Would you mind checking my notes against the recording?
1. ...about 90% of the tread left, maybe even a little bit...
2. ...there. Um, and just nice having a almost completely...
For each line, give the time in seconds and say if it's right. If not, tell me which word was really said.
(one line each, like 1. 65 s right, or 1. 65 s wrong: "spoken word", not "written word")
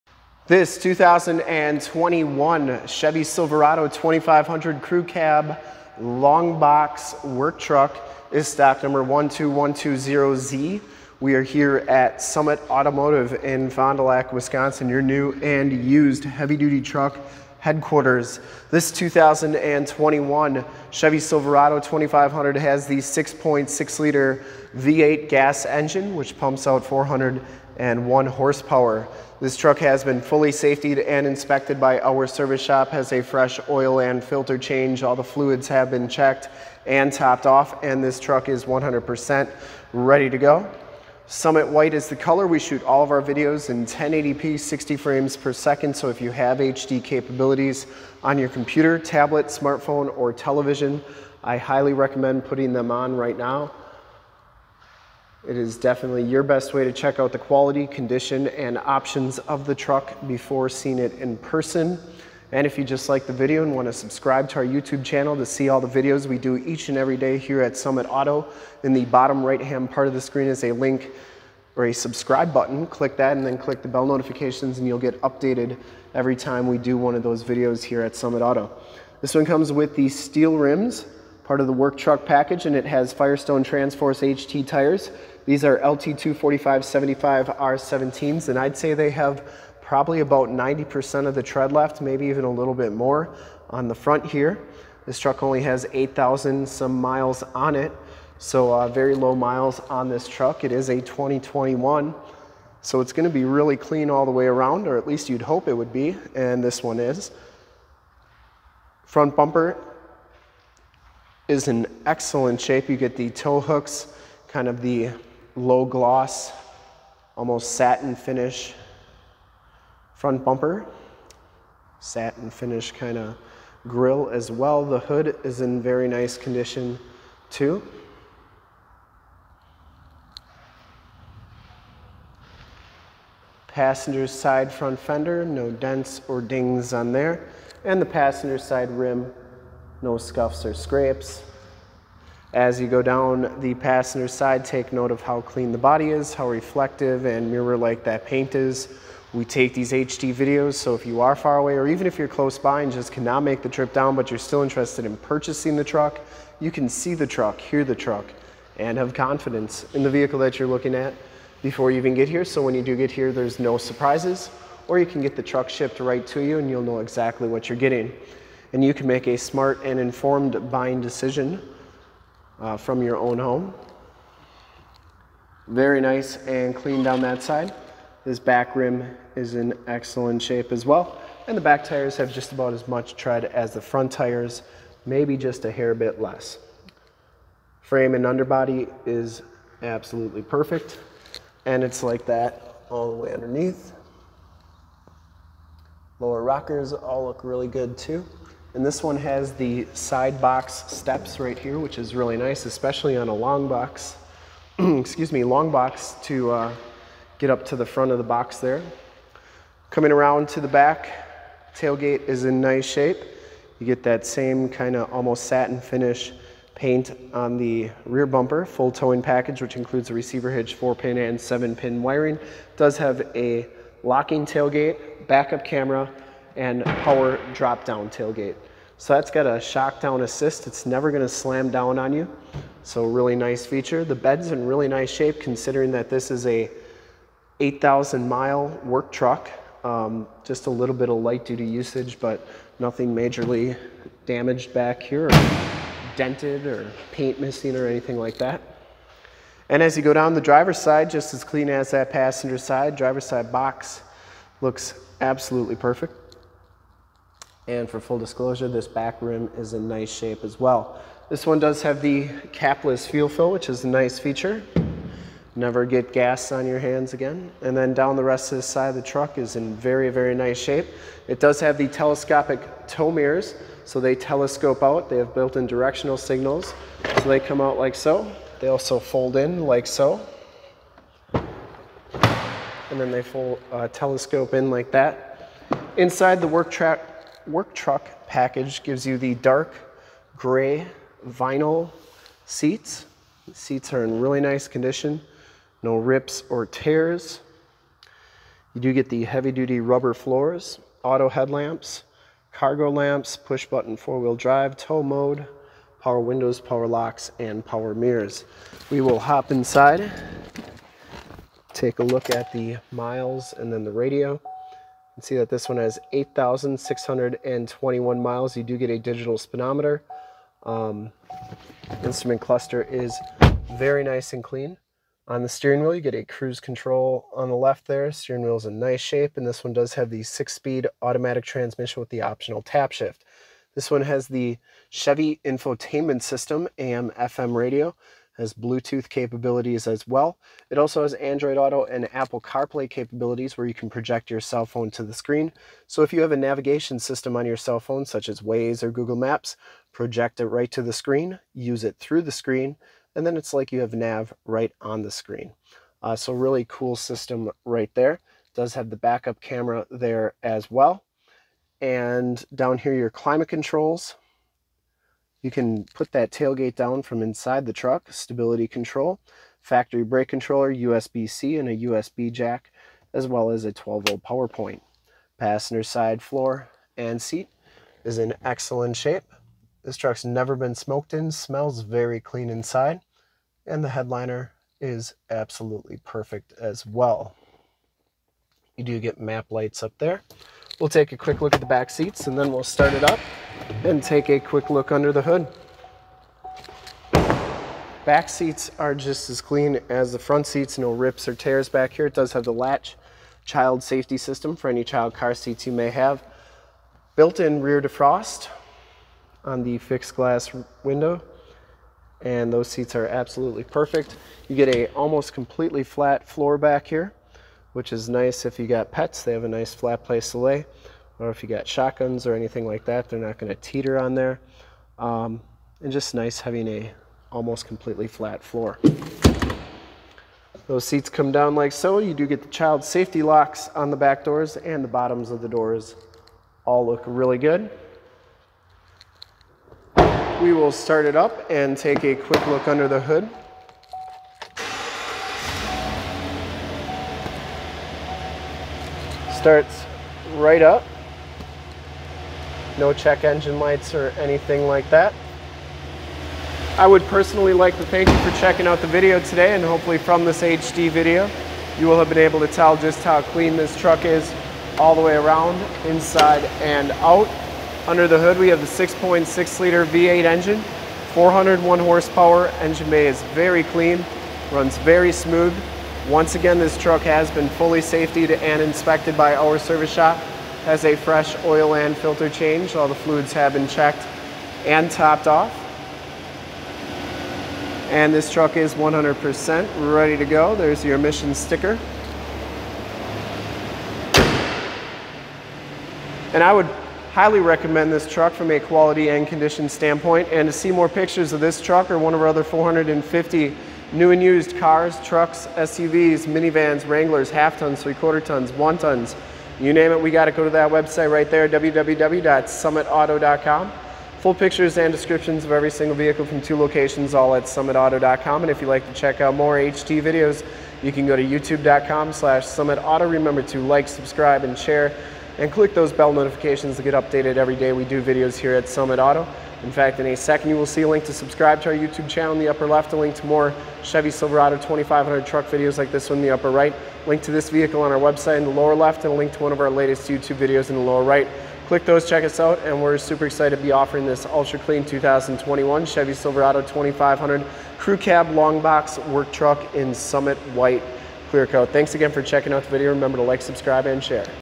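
1. 90 s right
2. 424 s right.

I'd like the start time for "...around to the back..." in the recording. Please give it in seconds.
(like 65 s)
210 s.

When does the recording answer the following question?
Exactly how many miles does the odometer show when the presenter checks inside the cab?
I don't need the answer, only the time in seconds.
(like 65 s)
316 s.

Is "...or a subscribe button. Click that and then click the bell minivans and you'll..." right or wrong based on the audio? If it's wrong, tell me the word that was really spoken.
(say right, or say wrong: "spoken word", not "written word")
wrong: "notifications", not "minivans".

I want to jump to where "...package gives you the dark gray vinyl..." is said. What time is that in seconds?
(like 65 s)
288 s.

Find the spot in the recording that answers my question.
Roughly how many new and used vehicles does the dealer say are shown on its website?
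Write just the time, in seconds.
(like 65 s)
502 s.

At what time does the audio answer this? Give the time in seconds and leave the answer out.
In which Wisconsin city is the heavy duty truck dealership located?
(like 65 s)
13 s.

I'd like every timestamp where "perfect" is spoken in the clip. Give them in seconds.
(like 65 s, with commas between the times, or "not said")
190 s, 255 s, 386 s, 413 s.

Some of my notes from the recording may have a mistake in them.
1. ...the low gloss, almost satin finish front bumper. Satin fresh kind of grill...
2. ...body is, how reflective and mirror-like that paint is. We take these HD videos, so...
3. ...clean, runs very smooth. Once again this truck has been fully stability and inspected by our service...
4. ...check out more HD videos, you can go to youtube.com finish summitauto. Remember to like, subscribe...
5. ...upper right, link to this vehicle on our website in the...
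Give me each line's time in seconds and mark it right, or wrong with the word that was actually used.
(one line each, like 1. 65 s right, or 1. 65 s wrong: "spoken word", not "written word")
1. 114 s wrong: "finish", not "fresh"
2. 145 s right
3. 473 s wrong: "safety", not "stability"
4. 518 s wrong: "slash", not "finish"
5. 536 s right.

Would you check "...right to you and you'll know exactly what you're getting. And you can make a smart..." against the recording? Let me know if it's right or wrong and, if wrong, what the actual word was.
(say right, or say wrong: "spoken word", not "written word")
right.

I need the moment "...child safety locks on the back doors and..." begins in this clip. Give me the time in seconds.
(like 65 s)
432 s.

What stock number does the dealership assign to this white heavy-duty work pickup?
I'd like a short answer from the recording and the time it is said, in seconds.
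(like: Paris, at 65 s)
12120Z, at 9 s.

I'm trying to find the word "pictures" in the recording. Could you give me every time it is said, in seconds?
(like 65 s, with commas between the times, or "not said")
500 s, 514 s.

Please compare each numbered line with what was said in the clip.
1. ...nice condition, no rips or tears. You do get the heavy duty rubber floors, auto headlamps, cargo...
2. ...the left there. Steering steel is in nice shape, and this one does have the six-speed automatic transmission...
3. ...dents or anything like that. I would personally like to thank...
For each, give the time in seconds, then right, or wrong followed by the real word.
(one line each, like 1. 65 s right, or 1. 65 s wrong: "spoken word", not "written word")
1. 294 s right
2. 327 s wrong: "wheel", not "steel"
3. 453 s wrong: "lights", not "dents".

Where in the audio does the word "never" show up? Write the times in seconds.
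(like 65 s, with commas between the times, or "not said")
230 s, 265 s, 380 s.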